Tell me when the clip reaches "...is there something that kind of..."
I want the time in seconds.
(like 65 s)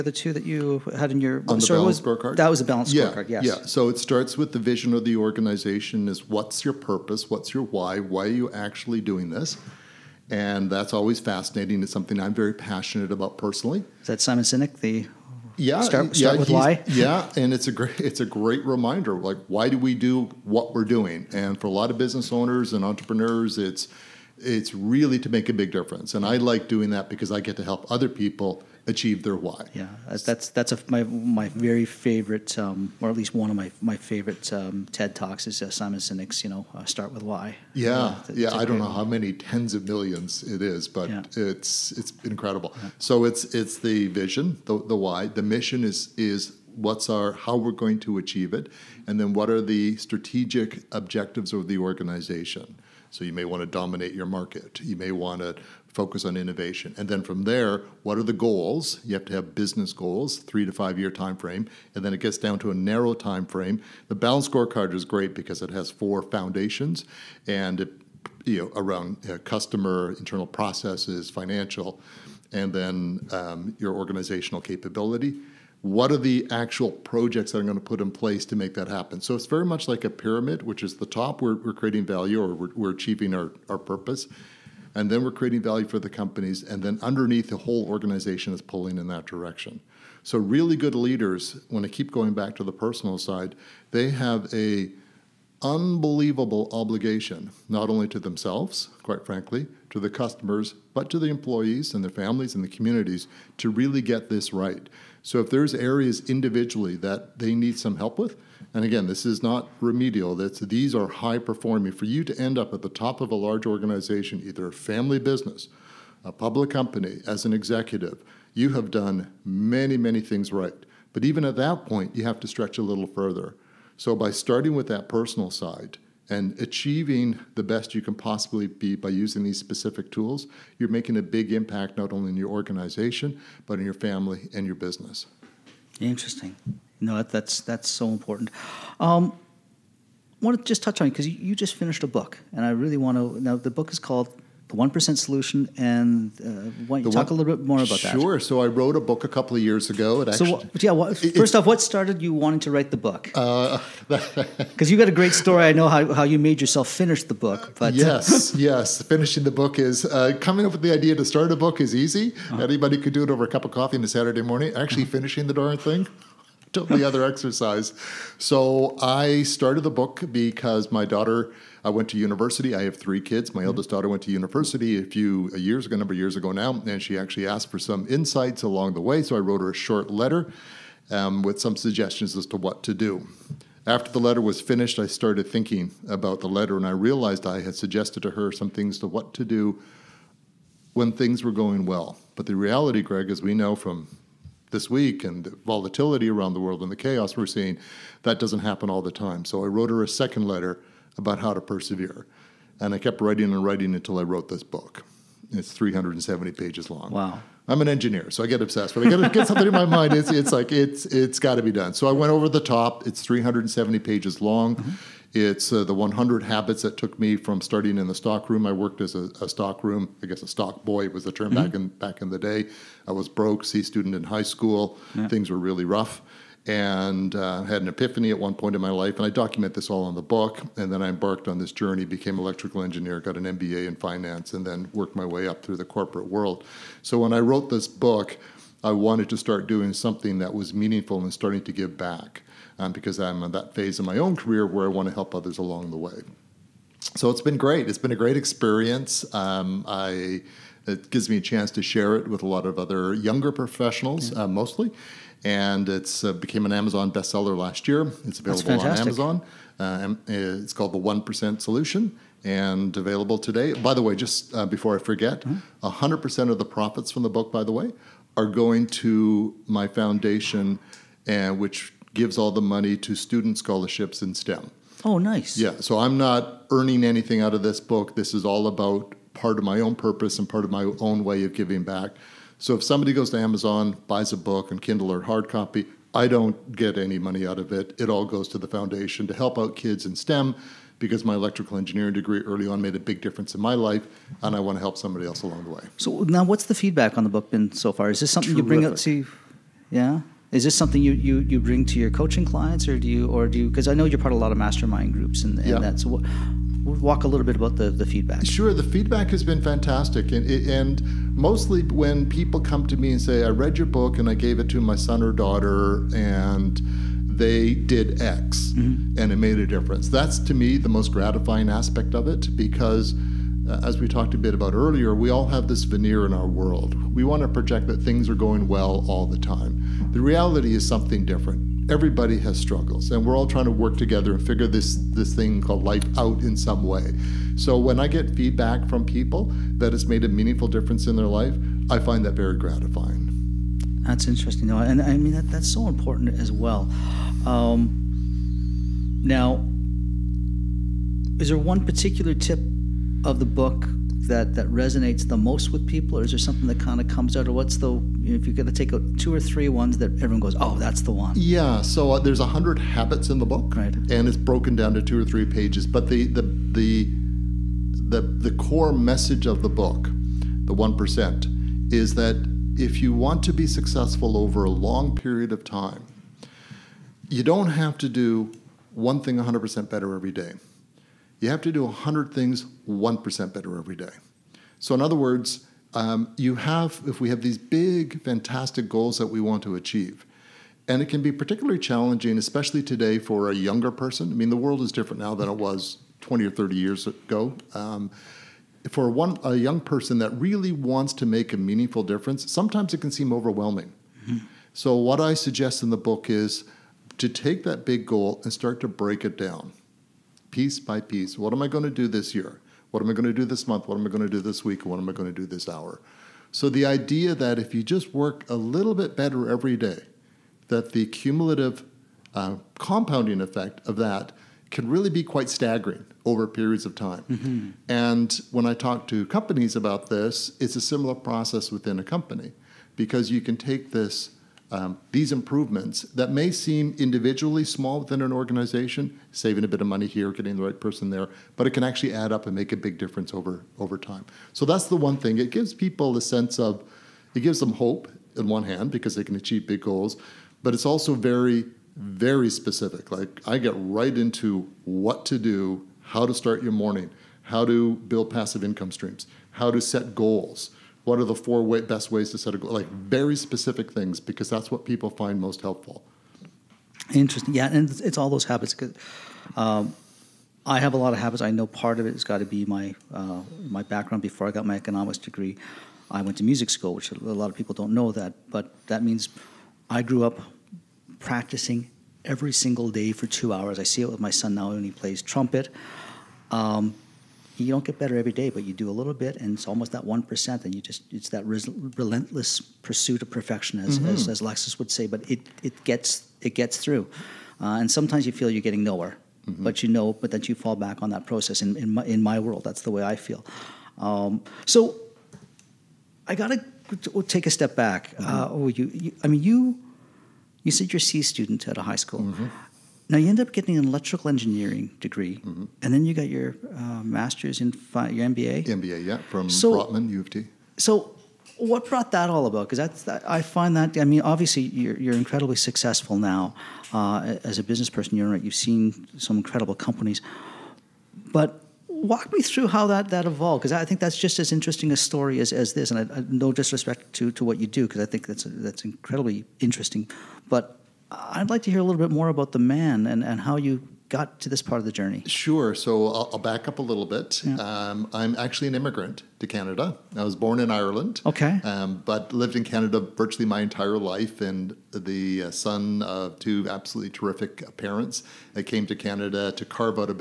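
356 s.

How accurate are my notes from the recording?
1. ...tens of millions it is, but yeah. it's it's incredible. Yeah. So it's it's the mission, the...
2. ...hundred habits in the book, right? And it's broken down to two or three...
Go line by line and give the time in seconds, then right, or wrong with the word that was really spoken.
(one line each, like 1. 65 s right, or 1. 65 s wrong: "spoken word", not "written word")
1. 39 s wrong: "vision", not "mission"
2. 362 s right.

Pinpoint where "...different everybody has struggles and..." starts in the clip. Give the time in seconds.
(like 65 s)
331 s.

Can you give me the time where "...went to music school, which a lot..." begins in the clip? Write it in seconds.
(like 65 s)
476 s.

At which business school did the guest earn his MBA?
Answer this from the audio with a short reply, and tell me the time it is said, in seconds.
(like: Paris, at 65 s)
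Rotman, at 519 s.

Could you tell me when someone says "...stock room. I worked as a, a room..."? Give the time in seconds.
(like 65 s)
218 s.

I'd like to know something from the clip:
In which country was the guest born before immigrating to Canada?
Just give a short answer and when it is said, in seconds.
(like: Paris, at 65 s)
Ireland, at 550 s.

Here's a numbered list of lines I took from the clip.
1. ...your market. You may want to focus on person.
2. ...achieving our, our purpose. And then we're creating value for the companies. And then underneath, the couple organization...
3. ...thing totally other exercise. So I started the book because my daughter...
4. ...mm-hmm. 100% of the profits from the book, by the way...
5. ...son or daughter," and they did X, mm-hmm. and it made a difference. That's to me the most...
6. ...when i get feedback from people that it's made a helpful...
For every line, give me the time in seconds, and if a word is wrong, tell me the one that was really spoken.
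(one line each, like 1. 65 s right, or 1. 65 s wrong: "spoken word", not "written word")
1. 54 s wrong: "innovation", not "person"
2. 82 s wrong: "whole", not "couple"
3. 165 s right
4. 265 s right
5. 314 s right
6. 337 s wrong: "meaningful", not "helpful".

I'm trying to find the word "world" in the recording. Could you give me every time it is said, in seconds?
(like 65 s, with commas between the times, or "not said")
196 s, 236 s, 326 s, 394 s, 502 s.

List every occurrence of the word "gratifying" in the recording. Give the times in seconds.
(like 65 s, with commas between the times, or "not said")
321 s, 342 s.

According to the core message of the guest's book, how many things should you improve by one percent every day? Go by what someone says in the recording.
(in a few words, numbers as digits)
100.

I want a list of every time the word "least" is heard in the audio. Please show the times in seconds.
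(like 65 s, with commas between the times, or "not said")
33 s.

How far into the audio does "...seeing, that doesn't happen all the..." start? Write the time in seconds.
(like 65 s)
197 s.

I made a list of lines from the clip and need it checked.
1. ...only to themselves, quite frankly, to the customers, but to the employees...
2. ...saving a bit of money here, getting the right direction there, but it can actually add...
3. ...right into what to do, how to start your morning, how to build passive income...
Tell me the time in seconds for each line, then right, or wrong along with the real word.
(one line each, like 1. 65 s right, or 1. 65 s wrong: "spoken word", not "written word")
1. 97 s right
2. 439 s wrong: "person", not "direction"
3. 453 s right.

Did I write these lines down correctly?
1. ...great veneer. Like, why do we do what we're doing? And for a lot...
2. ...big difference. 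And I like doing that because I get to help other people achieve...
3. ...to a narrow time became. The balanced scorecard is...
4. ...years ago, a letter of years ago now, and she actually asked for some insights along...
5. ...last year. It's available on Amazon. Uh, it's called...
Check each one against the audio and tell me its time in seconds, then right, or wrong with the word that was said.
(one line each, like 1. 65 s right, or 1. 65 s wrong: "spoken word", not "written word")
1. 18 s wrong: "reminder", not "veneer"
2. 25 s right
3. 62 s wrong: "frame", not "became"
4. 175 s wrong: "number", not "letter"
5. 257 s right.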